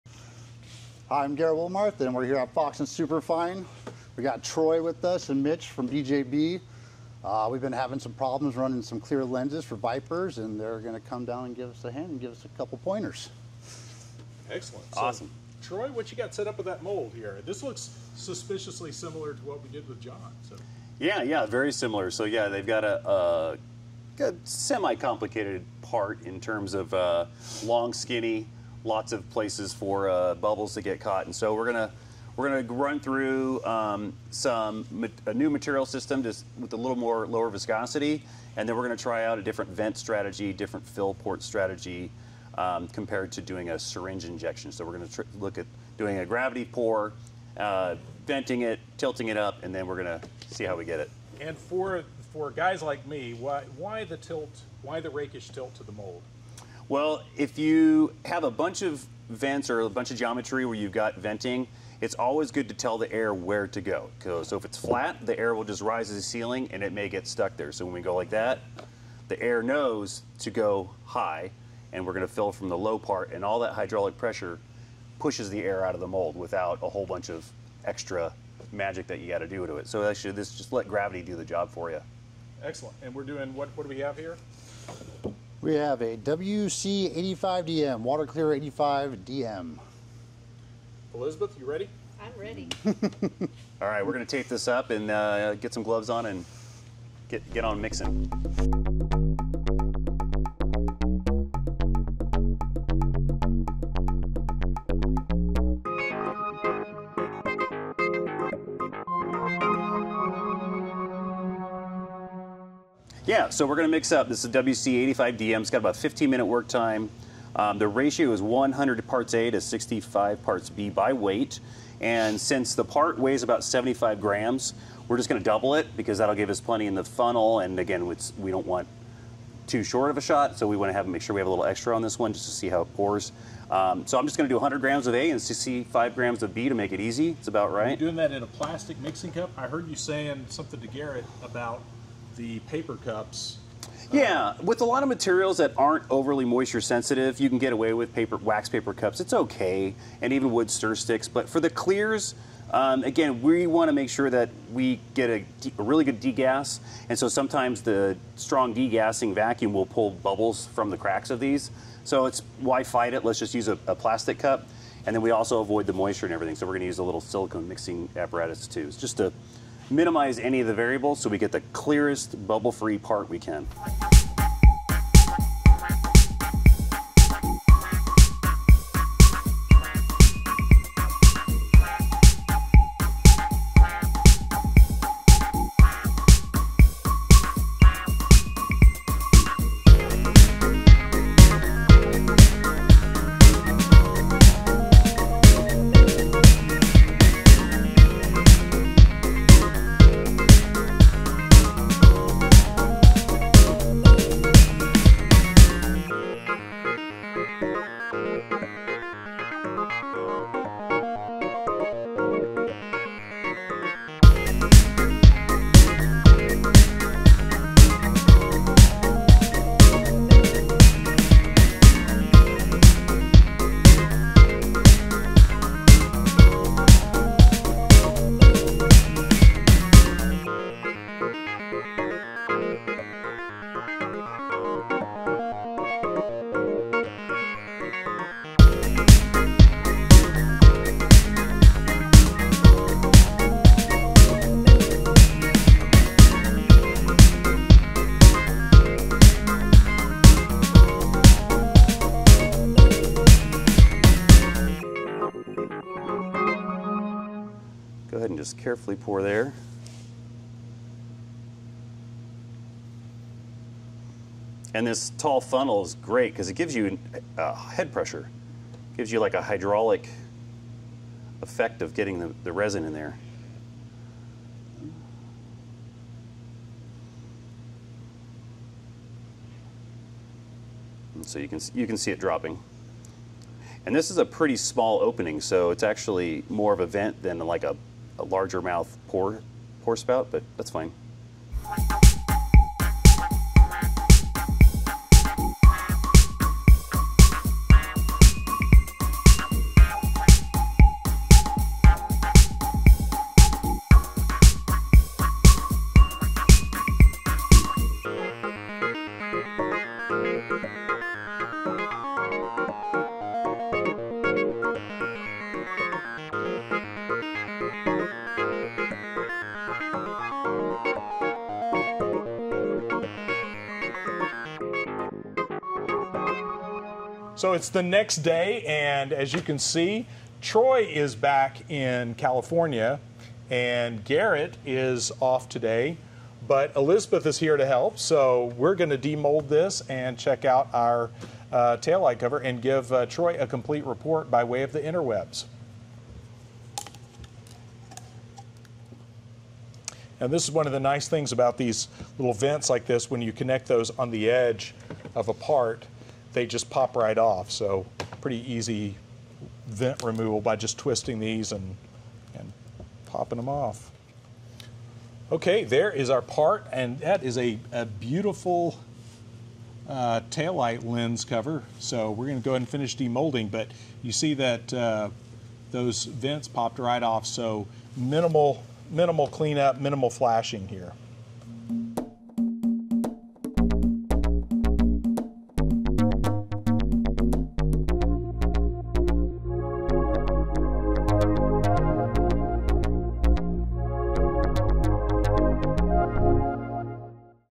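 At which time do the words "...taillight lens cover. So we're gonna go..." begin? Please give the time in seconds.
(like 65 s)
370 s.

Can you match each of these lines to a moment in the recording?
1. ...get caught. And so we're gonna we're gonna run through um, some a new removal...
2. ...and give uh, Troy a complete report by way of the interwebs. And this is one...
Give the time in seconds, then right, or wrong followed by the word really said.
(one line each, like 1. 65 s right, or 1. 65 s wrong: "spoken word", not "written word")
1. 30 s wrong: "material", not "removal"
2. 342 s right.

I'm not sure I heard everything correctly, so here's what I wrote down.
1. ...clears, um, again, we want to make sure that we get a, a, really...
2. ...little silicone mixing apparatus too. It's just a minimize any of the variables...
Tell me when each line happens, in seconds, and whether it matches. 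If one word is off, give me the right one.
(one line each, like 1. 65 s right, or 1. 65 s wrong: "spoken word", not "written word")
1. 151 s right
2. 167 s right.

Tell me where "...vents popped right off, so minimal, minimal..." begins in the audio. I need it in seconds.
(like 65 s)
376 s.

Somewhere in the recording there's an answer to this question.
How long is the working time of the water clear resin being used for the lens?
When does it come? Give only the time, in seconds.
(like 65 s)
115 s.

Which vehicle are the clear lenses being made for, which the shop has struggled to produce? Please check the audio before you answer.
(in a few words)
Vipers.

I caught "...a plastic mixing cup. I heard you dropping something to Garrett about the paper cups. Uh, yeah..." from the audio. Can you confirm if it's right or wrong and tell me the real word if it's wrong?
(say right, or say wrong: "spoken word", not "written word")
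wrong: "saying", not "dropping".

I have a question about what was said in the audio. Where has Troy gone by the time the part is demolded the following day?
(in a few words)
California.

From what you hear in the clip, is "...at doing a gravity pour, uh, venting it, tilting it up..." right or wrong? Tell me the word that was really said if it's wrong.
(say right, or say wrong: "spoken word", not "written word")
right.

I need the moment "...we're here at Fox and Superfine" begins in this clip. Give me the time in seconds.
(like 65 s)
2 s.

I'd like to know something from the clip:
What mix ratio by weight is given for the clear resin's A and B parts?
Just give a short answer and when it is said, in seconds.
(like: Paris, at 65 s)
100 parts A to 65 parts B, at 118 s.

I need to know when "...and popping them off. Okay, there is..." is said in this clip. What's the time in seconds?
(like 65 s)
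362 s.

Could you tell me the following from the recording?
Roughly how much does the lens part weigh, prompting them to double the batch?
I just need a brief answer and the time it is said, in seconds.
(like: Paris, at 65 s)
75 grams, at 123 s.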